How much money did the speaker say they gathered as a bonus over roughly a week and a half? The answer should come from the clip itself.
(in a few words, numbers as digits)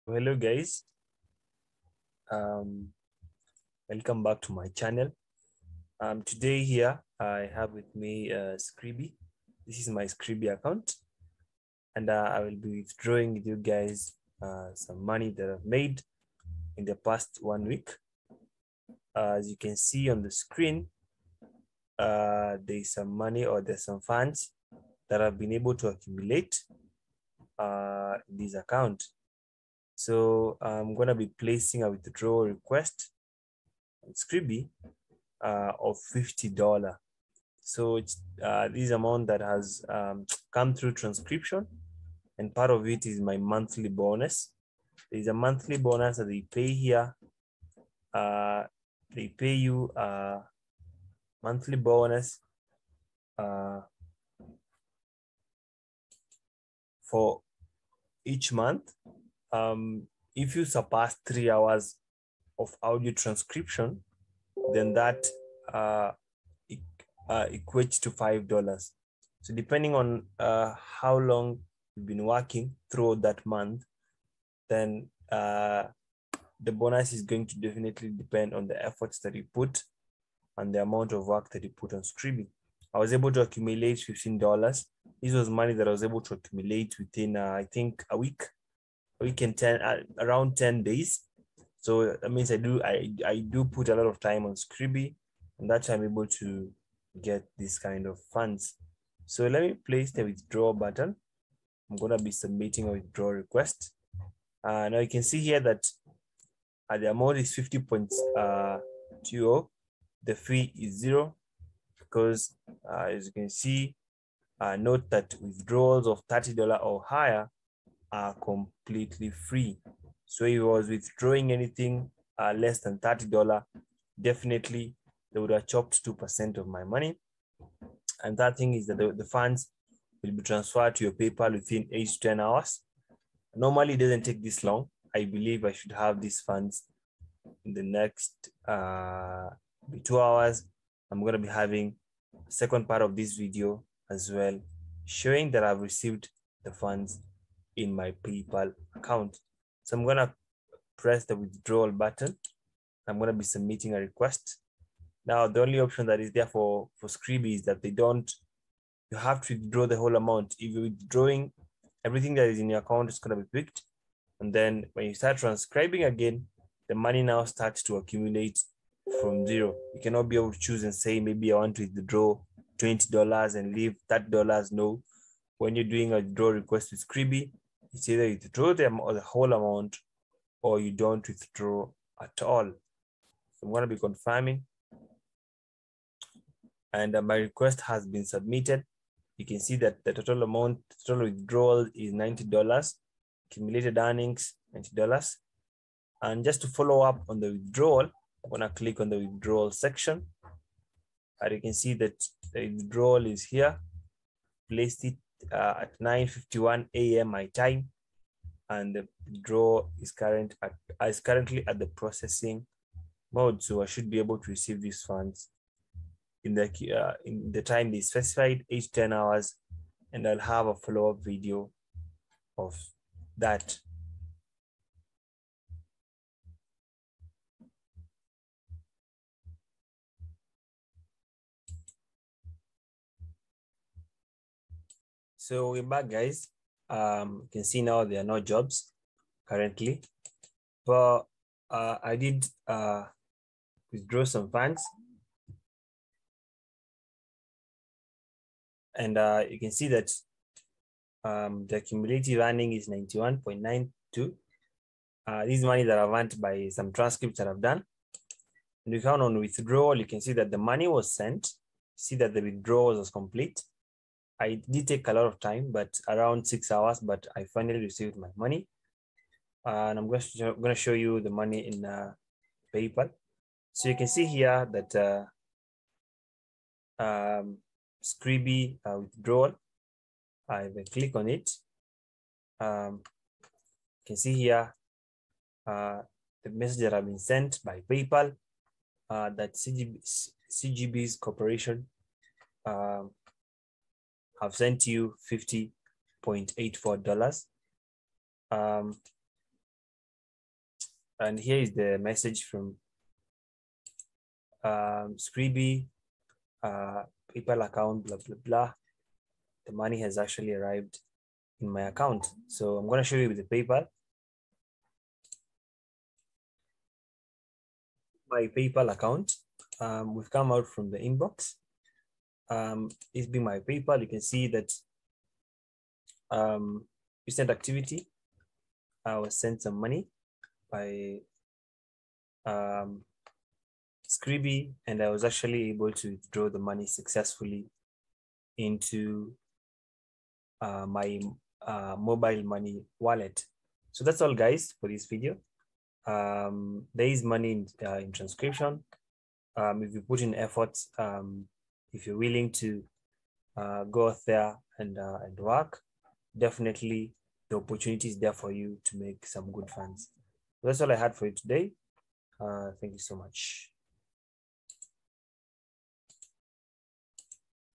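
$15.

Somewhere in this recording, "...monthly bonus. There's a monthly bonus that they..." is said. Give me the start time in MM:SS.
00:43.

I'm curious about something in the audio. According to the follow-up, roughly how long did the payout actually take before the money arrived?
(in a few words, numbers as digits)
6 hours.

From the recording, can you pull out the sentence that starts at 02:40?
If you're withdrawing, everything that is in your account is gonna be picked.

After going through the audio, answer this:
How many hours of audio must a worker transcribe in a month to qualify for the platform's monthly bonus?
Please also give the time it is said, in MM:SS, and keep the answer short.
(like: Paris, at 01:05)
3 hours, at 01:01.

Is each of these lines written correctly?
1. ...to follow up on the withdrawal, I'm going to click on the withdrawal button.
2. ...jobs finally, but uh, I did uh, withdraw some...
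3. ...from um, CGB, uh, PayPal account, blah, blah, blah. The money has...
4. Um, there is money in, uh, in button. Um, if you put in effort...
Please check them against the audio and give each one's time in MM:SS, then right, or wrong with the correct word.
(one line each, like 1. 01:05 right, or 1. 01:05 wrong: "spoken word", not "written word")
1. 03:16 wrong: "section", not "button"
2. 03:58 wrong: "currently", not "finally"
3. 05:02 wrong: "Scribie", not "CGB"
4. 05:46 wrong: "transcription", not "button".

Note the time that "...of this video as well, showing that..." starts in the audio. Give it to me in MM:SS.
02:23.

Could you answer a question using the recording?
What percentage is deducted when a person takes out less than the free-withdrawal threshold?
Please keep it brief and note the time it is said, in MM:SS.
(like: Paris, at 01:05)
2%, at 02:06.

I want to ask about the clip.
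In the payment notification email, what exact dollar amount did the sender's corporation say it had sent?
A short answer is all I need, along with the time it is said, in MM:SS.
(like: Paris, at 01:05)
$50.84, at 04:55.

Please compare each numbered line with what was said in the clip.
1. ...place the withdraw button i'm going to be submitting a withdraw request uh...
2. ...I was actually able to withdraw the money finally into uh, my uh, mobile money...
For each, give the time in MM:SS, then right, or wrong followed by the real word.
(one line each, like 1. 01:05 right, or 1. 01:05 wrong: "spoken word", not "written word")
1. 01:39 right
2. 05:35 wrong: "successfully", not "finally".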